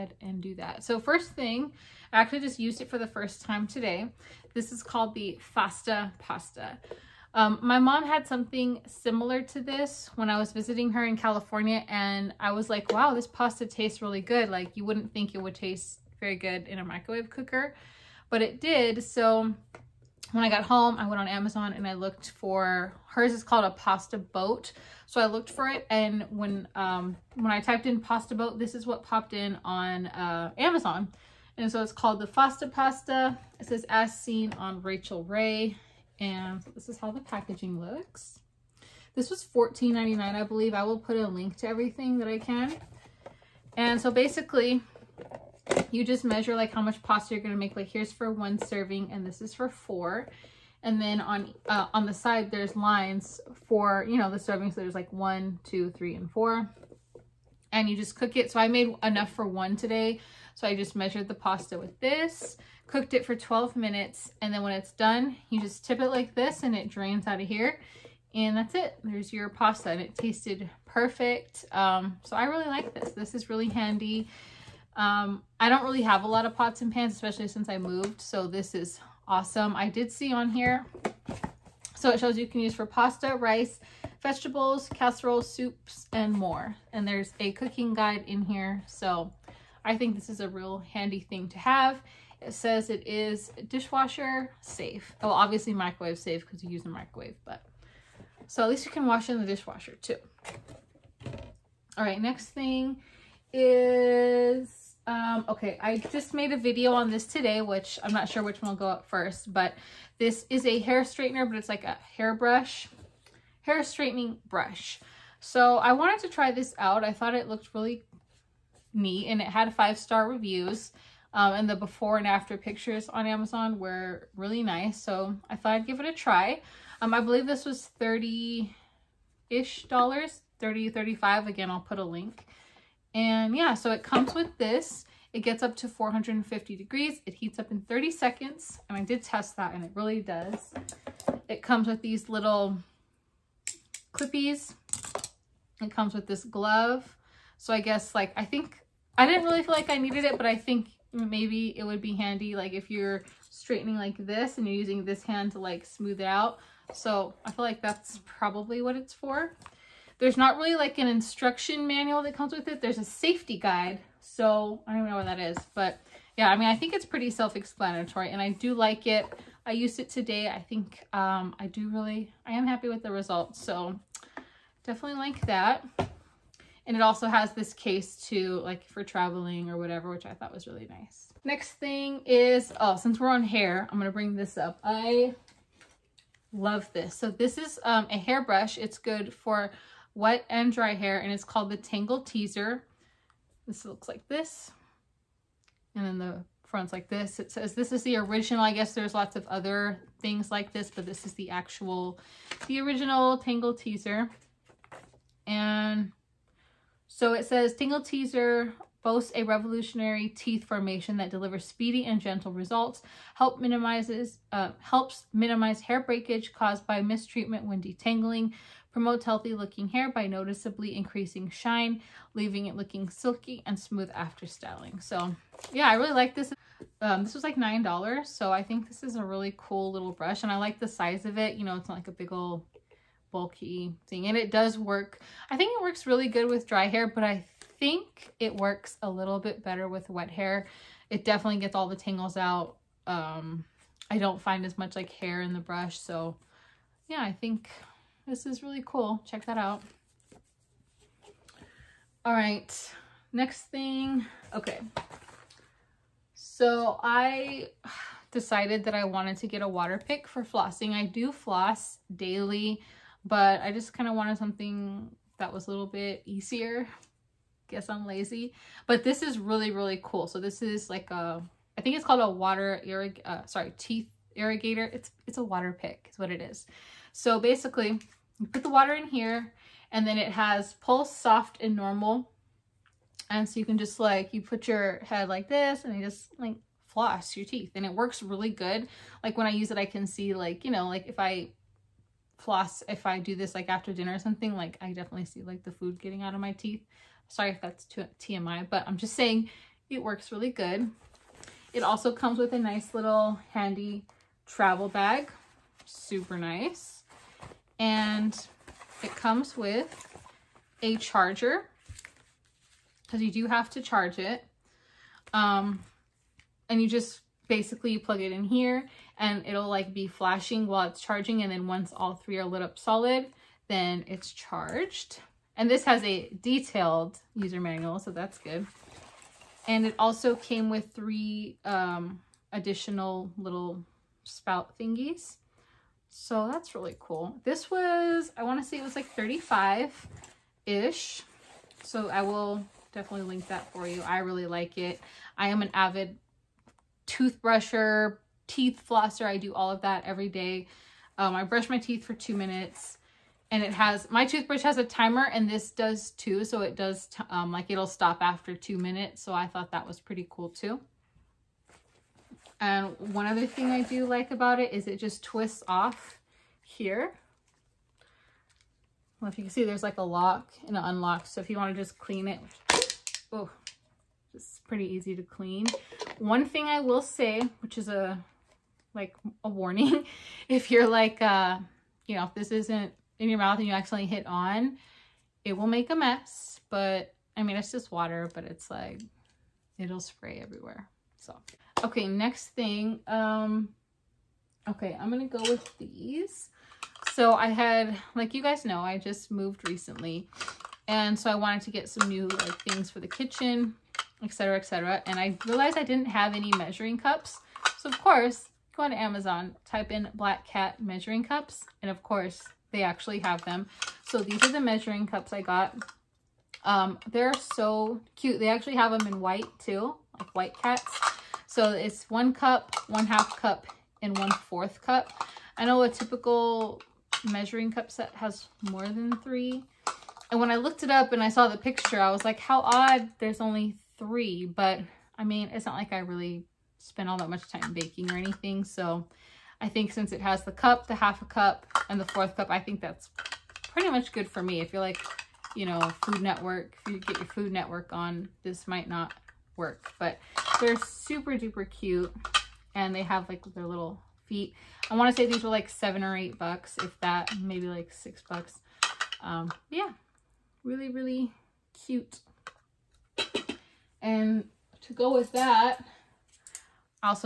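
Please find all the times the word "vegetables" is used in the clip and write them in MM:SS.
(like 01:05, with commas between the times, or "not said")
01:24.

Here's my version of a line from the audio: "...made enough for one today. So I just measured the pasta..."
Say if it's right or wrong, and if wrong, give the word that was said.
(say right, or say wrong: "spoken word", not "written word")
right.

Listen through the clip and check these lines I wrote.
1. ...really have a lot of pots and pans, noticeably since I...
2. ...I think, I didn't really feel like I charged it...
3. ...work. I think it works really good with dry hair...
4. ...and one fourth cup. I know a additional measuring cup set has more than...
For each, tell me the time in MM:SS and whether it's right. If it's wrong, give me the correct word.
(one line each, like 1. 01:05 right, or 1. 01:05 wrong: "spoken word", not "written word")
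1. 01:15 wrong: "especially", not "noticeably"
2. 02:28 wrong: "needed", not "charged"
3. 03:54 right
4. 07:04 wrong: "typical", not "additional".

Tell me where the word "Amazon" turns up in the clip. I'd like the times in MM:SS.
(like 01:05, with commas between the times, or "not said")
00:21, 00:30, 02:03, 06:48.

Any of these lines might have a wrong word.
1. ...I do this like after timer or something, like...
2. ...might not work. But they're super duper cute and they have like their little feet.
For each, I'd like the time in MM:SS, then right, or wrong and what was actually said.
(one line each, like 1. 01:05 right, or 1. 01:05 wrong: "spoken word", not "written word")
1. 04:53 wrong: "dinner", not "timer"
2. 07:28 right.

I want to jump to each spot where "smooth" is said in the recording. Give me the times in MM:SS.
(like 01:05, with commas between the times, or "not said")
02:35, 03:43.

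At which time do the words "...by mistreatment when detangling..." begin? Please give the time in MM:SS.
03:36.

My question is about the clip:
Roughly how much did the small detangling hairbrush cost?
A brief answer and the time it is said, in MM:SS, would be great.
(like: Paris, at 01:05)
$9, at 03:47.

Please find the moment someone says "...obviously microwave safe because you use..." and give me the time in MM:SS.
01:35.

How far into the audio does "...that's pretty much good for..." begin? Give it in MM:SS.
07:22.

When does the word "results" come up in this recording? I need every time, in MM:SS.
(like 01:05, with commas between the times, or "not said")
02:53, 03:32.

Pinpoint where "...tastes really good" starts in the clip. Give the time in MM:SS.
00:13.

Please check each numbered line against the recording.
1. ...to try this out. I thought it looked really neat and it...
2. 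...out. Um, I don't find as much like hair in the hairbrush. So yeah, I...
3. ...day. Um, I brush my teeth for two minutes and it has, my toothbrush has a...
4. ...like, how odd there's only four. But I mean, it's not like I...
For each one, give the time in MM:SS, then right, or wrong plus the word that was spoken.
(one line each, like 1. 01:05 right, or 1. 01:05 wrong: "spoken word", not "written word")
1. 01:56 right
2. 04:02 wrong: "brush", not "hairbrush"
3. 05:50 right
4. 07:12 wrong: "three", not "four".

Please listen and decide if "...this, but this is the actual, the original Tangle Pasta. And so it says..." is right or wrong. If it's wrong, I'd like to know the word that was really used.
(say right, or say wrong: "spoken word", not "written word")
wrong: "Teezer", not "Pasta".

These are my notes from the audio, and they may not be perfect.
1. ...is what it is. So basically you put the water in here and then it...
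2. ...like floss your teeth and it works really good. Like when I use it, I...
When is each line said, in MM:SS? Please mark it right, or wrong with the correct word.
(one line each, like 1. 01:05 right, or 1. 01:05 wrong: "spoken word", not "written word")
1. 04:36 right
2. 04:46 right.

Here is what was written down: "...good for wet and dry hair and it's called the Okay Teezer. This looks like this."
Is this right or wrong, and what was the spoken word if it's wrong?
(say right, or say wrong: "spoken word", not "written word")
wrong: "Tangle", not "Okay".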